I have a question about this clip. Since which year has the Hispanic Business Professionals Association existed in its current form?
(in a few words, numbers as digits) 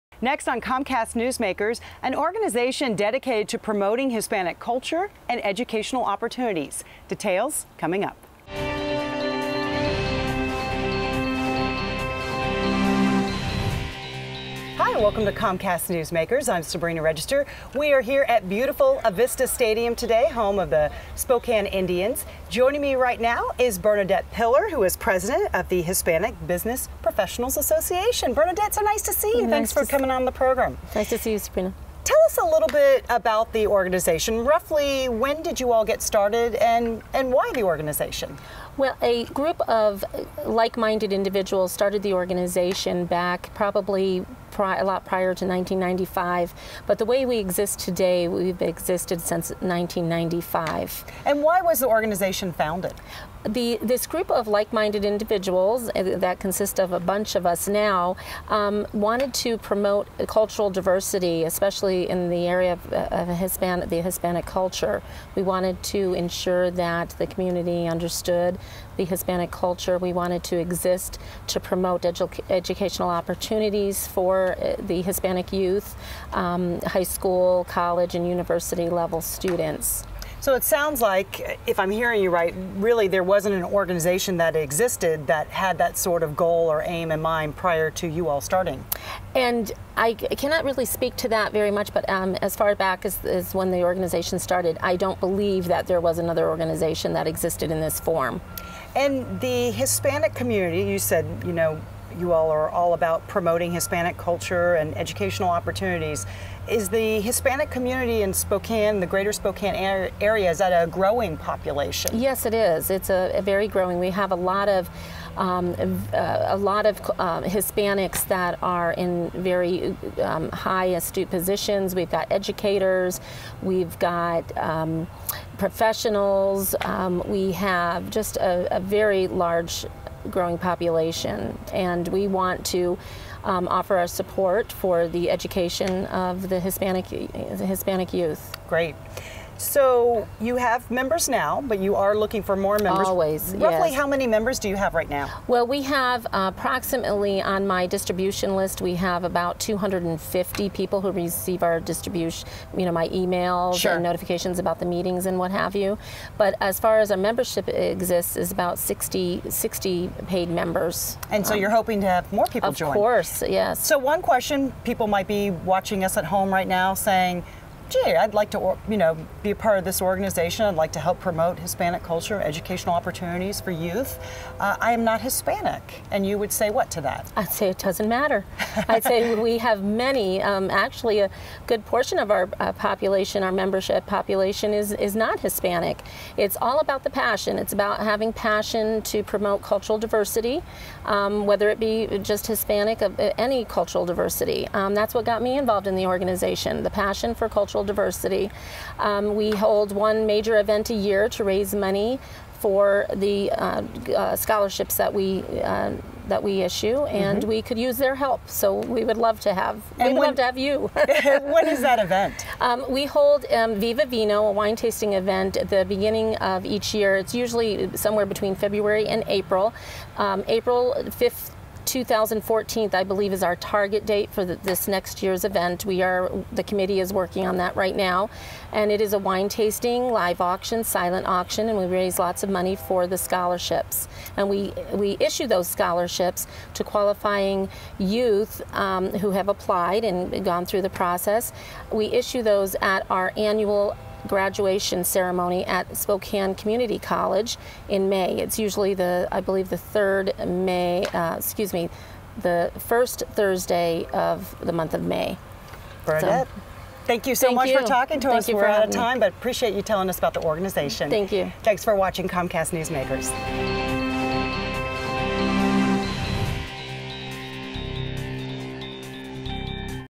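1995.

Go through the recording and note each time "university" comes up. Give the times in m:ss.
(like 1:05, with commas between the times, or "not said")
1:18.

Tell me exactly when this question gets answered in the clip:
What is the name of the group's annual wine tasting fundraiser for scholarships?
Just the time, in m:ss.
3:33.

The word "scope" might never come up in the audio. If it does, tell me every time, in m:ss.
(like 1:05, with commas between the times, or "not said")
not said.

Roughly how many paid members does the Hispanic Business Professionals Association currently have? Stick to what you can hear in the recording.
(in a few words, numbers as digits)
60.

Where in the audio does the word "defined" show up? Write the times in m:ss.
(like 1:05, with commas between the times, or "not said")
not said.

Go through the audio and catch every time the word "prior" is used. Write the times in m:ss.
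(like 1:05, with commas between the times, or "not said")
0:45, 1:27.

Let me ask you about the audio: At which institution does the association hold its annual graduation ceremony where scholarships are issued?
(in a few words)
Spokane Community College.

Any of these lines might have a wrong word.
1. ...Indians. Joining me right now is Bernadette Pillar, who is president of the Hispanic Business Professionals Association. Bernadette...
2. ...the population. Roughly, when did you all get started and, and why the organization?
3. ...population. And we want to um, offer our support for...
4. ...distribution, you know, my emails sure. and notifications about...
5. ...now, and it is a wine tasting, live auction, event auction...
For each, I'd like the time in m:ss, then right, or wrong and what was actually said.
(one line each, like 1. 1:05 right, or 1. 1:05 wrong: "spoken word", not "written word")
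1. 0:21 right
2. 0:33 wrong: "organization", not "population"
3. 2:10 right
4. 2:31 right
5. 3:47 wrong: "silent", not "event".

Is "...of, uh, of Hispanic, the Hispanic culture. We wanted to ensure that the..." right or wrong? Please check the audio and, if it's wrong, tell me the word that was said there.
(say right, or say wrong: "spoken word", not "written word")
right.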